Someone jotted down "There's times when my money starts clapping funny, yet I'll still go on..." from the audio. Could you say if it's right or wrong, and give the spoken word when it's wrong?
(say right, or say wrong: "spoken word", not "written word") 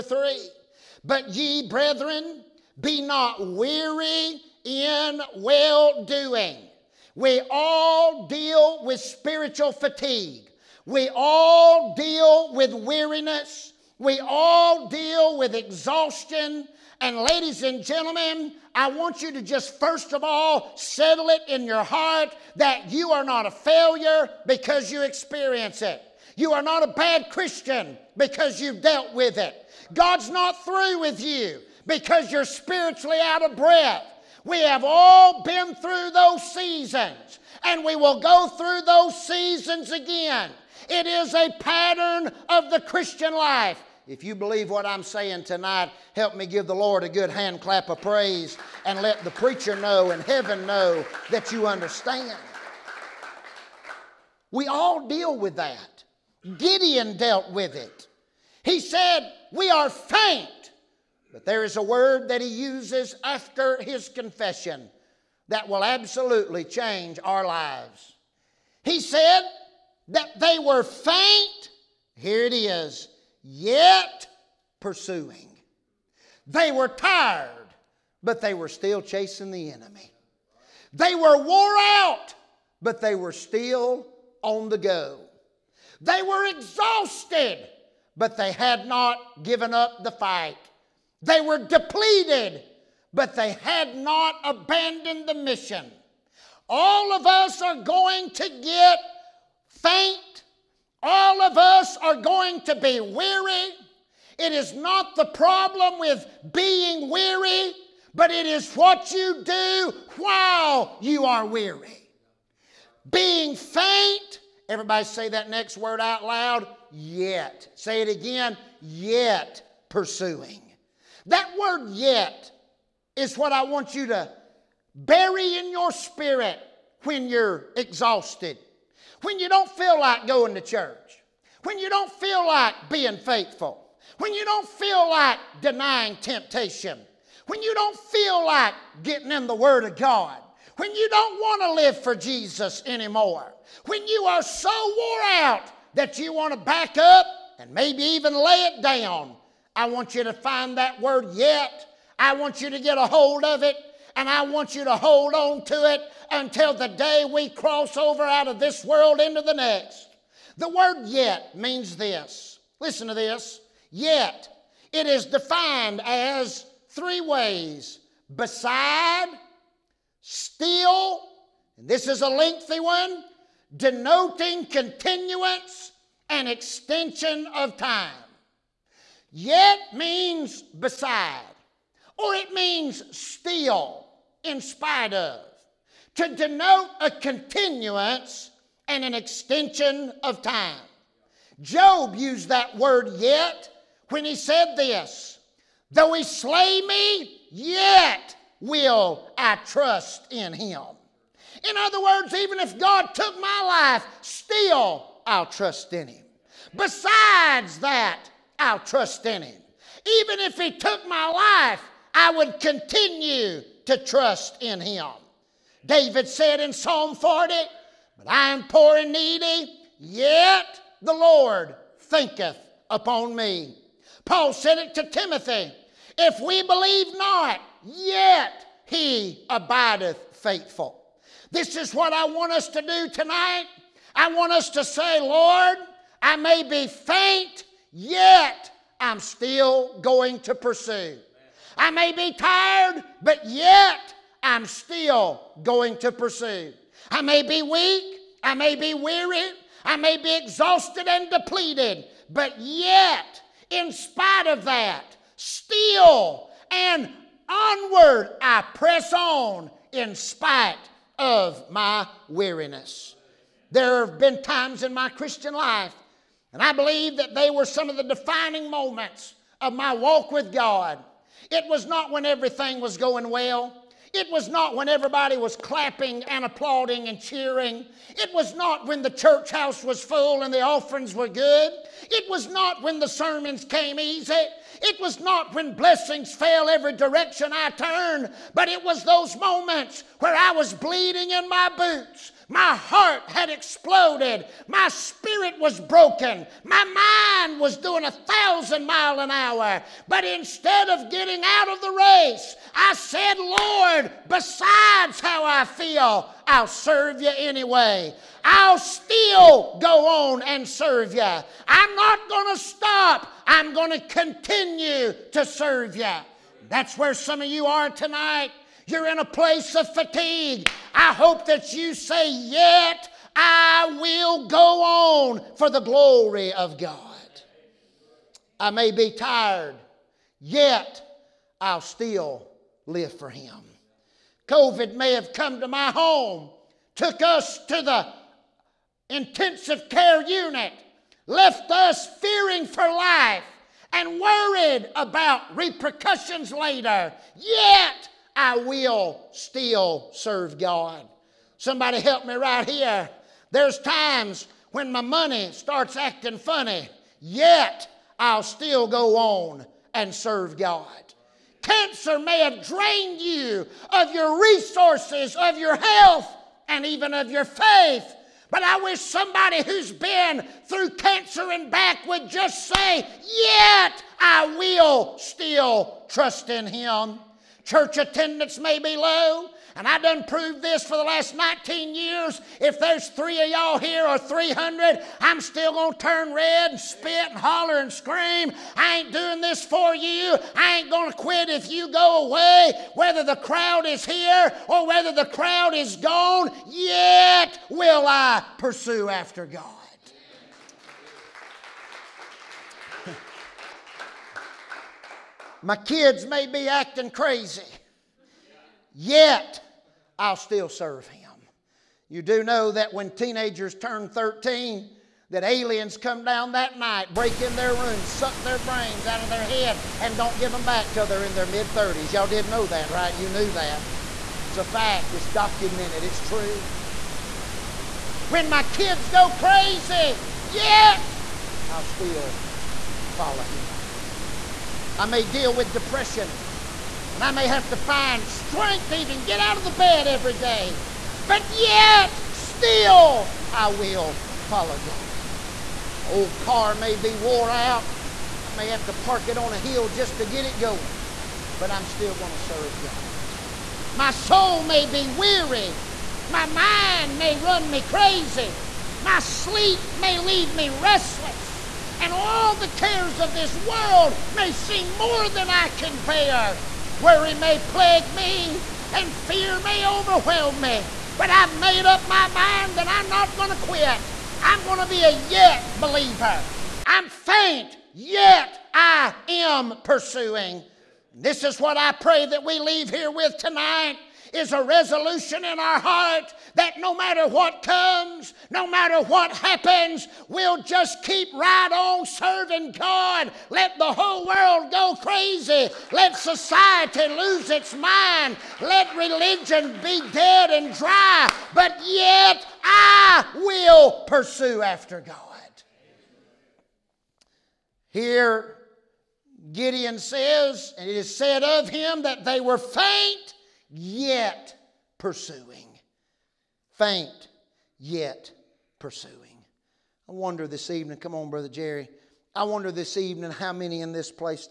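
wrong: "acting", not "clapping".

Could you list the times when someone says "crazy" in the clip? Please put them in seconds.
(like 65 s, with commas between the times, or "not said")
407 s, 429 s, 457 s, 495 s.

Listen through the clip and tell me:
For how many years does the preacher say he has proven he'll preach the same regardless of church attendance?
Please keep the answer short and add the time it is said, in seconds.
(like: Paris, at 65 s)
19, at 381 s.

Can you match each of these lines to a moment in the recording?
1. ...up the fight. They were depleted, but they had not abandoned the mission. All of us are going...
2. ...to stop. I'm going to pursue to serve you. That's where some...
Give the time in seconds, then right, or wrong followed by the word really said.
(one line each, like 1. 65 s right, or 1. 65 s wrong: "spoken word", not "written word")
1. 89 s right
2. 312 s wrong: "continue", not "pursue".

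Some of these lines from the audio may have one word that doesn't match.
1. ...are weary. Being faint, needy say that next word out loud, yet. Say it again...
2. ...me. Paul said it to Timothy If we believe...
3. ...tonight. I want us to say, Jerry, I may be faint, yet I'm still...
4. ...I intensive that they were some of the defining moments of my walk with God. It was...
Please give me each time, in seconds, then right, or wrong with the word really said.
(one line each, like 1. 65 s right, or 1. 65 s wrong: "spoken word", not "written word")
1. 111 s wrong: "everybody", not "needy"
2. 223 s right
3. 233 s wrong: "Lord", not "Jerry"
4. 266 s wrong: "believe", not "intensive".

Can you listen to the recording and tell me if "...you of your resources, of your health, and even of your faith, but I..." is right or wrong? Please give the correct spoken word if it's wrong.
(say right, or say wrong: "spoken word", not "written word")
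right.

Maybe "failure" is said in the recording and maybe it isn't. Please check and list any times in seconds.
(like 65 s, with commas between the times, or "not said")
23 s.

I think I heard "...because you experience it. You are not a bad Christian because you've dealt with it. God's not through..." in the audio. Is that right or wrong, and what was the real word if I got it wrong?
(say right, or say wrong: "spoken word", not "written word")
right.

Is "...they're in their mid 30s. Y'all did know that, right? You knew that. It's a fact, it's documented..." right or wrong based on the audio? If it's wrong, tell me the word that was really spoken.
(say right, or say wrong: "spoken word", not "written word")
right.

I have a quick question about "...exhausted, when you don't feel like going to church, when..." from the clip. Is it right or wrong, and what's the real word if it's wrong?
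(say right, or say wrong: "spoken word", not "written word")
right.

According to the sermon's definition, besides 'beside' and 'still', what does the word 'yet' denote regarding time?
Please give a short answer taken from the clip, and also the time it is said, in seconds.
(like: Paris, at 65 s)
continuance and extension, at 174 s.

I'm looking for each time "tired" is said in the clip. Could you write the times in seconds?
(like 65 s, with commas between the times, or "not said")
76 s, 242 s, 329 s.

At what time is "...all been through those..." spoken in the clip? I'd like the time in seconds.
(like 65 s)
34 s.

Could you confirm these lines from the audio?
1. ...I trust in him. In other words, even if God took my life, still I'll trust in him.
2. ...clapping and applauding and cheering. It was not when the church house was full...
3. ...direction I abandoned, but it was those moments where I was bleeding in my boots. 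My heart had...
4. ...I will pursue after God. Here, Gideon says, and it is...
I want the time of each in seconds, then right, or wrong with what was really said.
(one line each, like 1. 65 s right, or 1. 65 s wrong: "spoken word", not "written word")
1. 199 s right
2. 275 s right
3. 286 s wrong: "turned", not "abandoned"
4. 502 s right.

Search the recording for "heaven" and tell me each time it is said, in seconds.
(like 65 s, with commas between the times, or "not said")
50 s.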